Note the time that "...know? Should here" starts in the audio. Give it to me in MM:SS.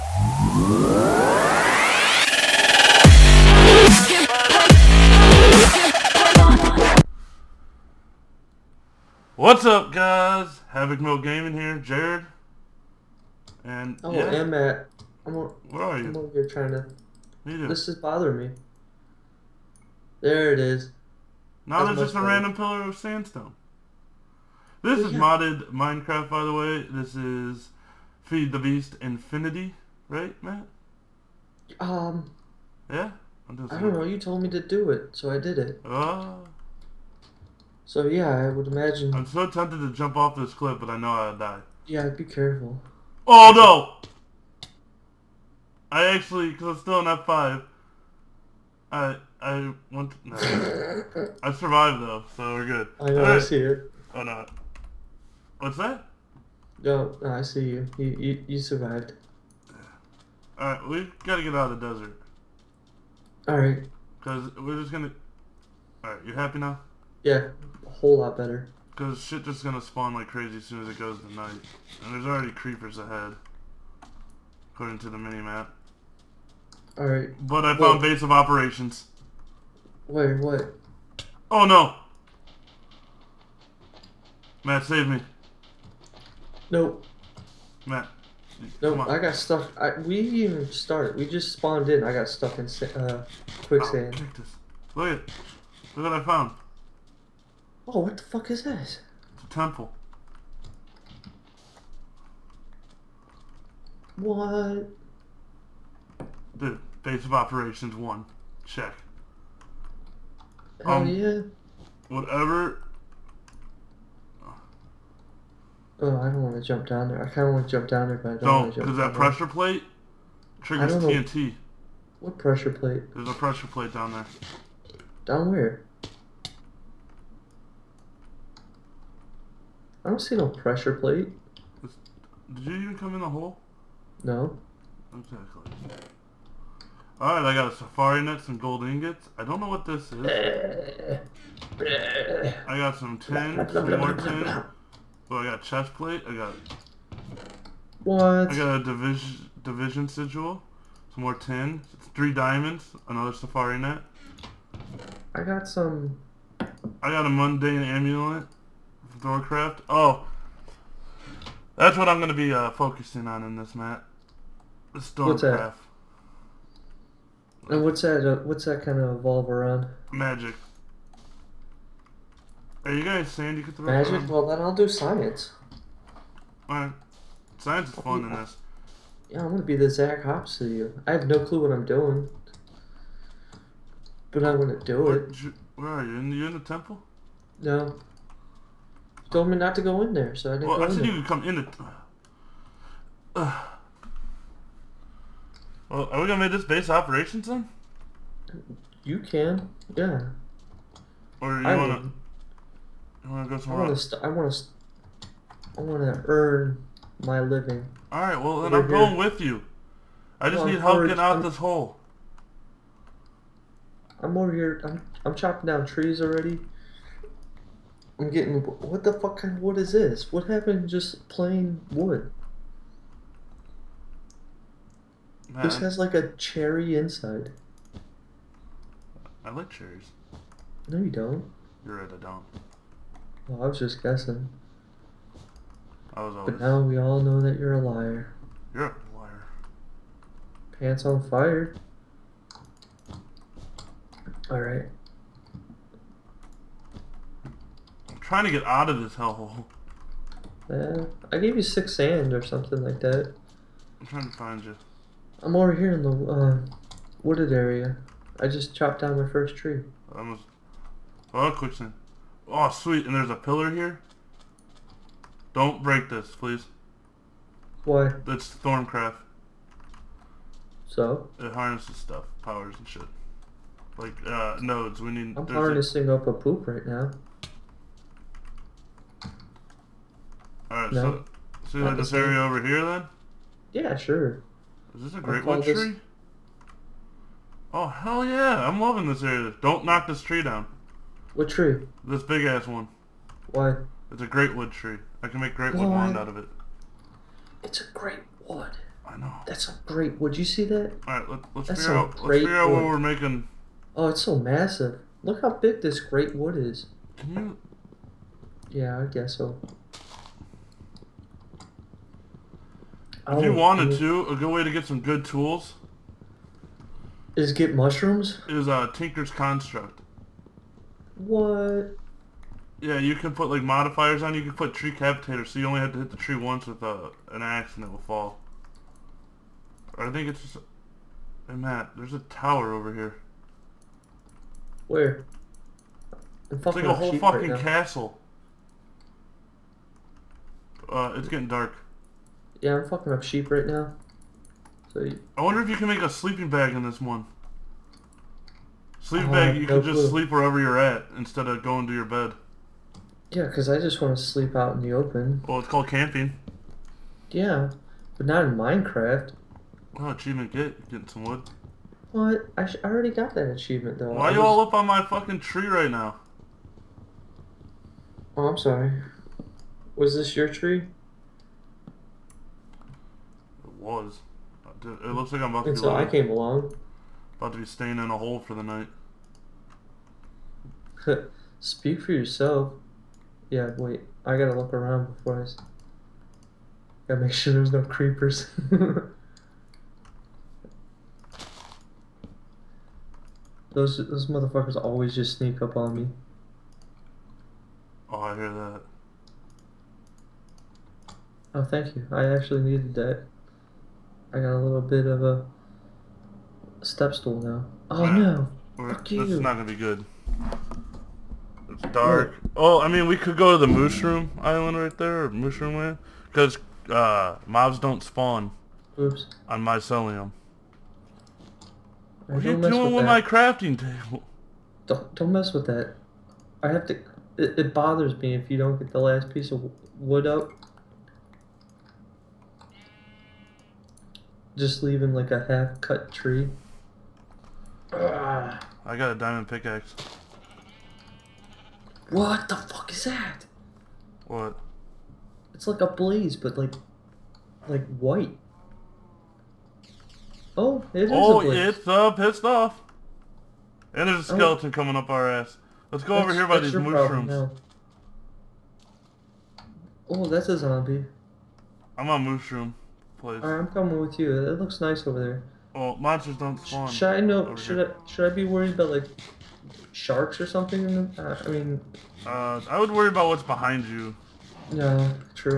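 07:47.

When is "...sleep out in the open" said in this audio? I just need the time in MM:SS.
05:54.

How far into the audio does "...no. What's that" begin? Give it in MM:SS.
00:54.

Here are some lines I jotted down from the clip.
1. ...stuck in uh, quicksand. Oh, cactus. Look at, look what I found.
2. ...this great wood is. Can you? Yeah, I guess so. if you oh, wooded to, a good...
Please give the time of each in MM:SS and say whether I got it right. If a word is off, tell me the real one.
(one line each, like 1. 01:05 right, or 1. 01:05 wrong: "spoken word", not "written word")
1. 01:32 right
2. 05:05 wrong: "wanted", not "wooded".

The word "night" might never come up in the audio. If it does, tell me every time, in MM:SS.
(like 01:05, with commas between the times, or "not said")
01:11, 06:18.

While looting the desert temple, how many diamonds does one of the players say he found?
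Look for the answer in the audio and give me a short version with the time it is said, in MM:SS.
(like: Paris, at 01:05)
3, at 02:32.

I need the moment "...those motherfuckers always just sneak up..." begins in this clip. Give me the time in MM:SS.
06:33.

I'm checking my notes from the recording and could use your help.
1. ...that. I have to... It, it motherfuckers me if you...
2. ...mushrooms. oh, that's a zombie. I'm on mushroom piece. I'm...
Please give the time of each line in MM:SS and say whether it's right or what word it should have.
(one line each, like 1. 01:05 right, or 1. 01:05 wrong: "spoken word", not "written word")
1. 07:05 wrong: "bothers", not "motherfuckers"
2. 07:36 wrong: "place", not "piece".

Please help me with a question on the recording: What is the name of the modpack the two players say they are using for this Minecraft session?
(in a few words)
Feed the Beast Infinity.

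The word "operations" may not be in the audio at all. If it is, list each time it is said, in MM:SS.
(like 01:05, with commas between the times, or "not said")
01:18, 01:47, 03:16.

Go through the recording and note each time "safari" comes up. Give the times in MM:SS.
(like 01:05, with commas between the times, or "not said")
02:17, 02:33.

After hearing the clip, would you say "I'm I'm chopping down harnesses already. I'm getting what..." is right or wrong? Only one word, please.
wrong.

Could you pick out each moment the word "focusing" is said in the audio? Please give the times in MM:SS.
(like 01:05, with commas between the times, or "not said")
02:42.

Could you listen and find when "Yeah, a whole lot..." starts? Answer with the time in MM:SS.
01:07.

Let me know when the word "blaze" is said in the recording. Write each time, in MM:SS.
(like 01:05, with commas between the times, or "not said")
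07:25, 07:31.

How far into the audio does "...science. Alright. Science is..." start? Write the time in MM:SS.
02:54.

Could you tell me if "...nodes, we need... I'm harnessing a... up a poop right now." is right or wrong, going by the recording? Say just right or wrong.
right.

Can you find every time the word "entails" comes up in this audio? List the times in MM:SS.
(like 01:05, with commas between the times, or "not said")
not said.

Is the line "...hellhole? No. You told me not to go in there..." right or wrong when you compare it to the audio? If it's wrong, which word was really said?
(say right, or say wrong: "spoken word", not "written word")
wrong: "temple", not "hellhole".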